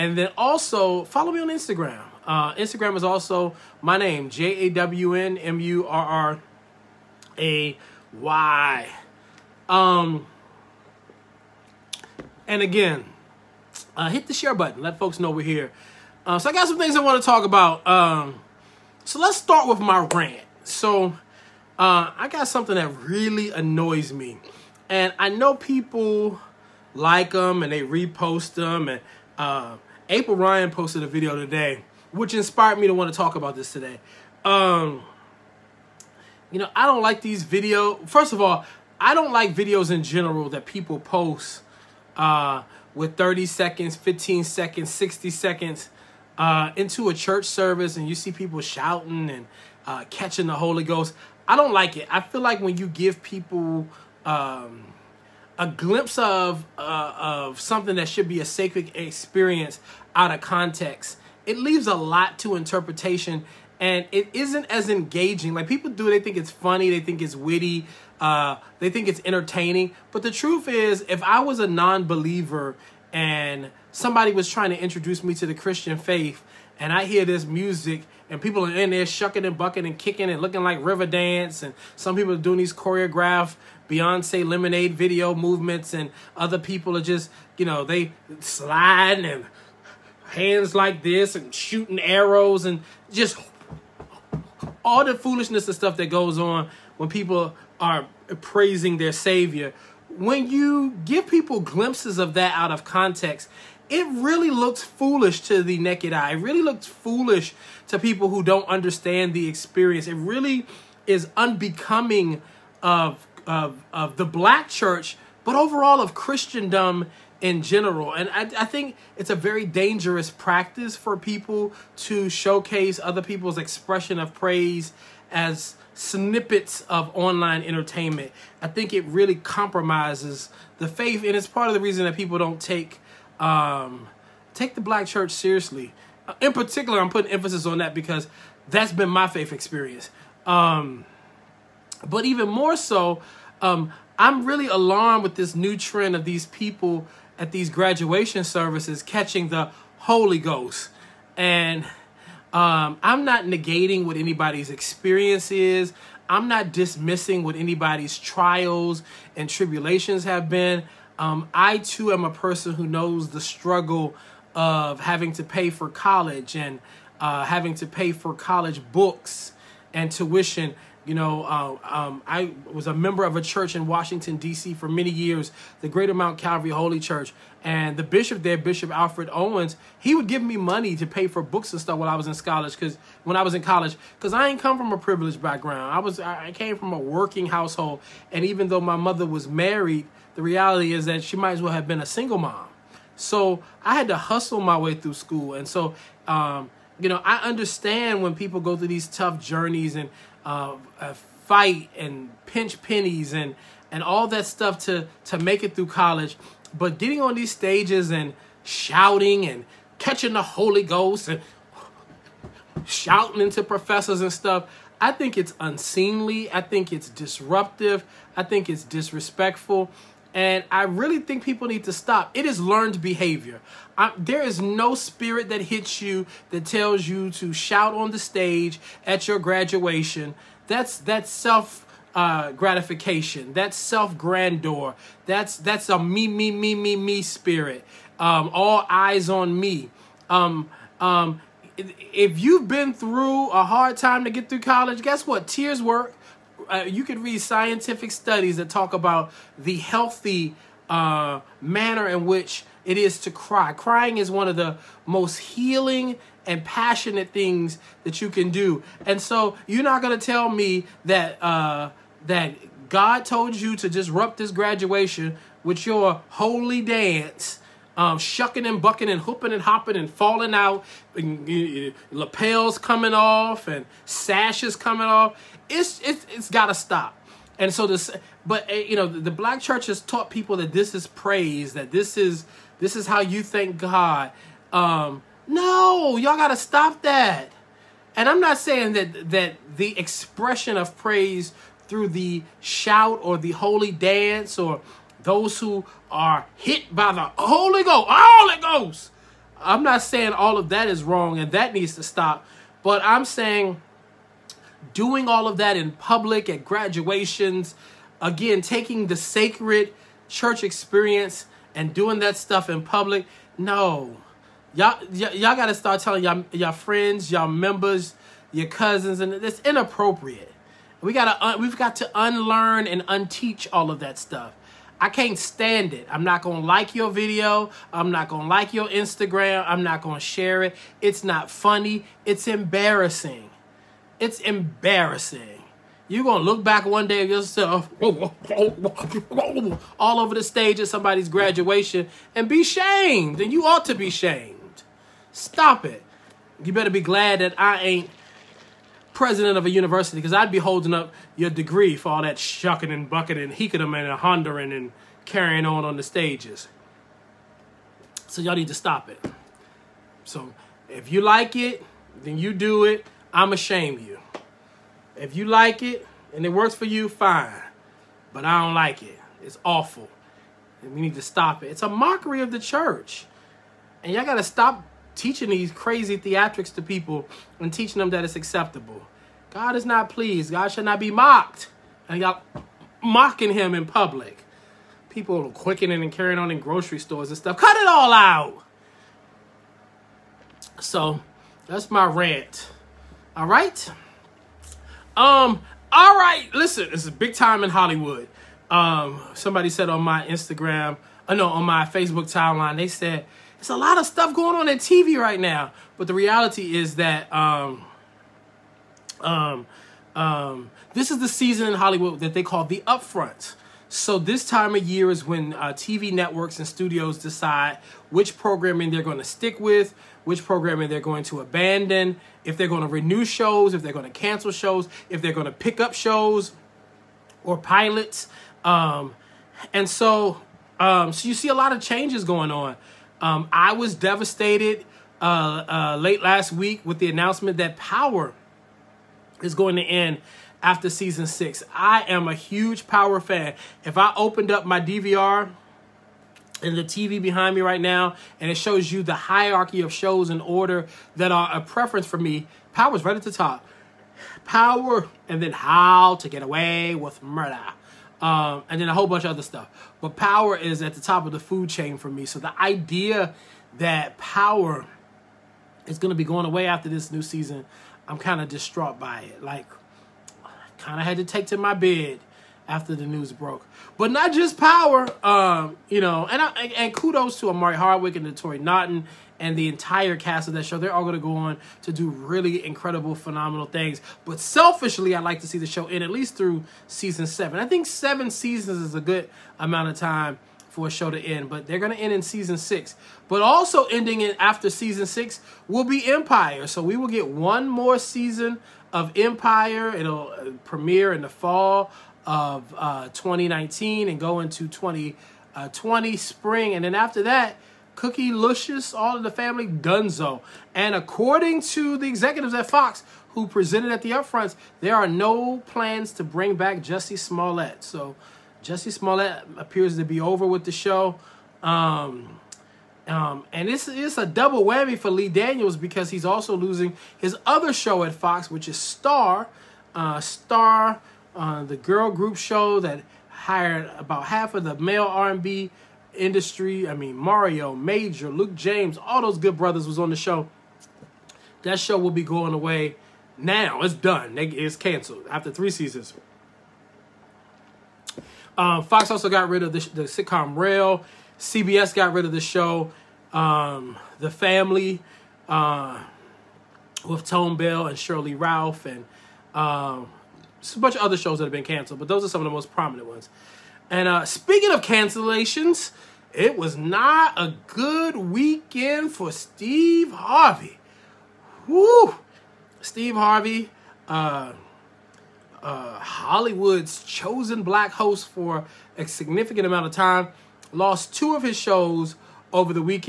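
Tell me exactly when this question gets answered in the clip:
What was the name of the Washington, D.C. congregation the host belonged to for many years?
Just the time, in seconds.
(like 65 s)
175 s.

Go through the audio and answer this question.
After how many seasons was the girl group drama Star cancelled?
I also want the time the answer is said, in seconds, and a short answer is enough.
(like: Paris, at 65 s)
3, at 545 s.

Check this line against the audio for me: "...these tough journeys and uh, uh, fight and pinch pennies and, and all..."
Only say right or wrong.
right.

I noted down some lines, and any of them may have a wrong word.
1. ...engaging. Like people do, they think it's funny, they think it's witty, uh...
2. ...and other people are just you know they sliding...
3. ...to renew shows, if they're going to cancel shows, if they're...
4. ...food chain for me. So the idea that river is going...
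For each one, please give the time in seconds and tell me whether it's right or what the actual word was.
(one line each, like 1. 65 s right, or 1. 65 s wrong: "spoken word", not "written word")
1. 64 s right
2. 85 s right
3. 422 s right
4. 461 s wrong: "power", not "river".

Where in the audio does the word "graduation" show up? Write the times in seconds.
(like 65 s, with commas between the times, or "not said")
147 s, 229 s, 264 s, 306 s, 341 s.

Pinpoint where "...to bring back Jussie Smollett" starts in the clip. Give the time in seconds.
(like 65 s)
516 s.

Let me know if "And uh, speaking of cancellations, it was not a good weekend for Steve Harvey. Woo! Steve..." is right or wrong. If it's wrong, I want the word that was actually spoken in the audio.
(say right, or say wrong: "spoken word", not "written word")
right.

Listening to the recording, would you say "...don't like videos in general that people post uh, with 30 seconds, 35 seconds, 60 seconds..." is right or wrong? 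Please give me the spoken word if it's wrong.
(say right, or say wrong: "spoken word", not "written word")
wrong: "15", not "35".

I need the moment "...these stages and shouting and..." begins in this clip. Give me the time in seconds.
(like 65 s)
207 s.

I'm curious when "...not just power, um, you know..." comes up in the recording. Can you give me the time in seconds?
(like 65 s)
474 s.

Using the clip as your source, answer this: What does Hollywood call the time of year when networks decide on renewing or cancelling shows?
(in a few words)
the upfront.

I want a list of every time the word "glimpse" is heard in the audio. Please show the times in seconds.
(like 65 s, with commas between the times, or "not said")
55 s, 101 s.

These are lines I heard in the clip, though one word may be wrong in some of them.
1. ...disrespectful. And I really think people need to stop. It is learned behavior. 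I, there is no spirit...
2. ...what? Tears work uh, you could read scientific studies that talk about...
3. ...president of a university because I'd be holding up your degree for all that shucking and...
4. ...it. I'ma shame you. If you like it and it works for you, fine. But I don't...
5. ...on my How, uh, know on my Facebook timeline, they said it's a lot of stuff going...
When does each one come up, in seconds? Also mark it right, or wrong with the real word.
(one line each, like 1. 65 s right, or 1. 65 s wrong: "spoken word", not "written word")
1. 218 s right
2. 245 s right
3. 349 s right
4. 362 s right
5. 399 s wrong: "Instagram", not "How".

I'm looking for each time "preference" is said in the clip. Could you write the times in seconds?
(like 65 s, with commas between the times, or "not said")
451 s.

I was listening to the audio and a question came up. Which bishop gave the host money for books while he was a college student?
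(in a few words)
Alfred Owens.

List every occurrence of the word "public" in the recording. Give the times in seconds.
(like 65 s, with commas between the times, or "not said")
305 s, 312 s, 383 s.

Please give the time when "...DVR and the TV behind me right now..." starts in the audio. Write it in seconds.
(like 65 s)
444 s.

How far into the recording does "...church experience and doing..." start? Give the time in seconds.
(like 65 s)
310 s.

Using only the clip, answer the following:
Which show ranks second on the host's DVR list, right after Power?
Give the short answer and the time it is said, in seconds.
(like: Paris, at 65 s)
How to Get Away with Murder, at 455 s.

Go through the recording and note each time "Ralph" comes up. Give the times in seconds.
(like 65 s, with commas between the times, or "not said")
558 s.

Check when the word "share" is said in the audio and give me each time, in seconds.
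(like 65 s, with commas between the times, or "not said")
14 s, 330 s.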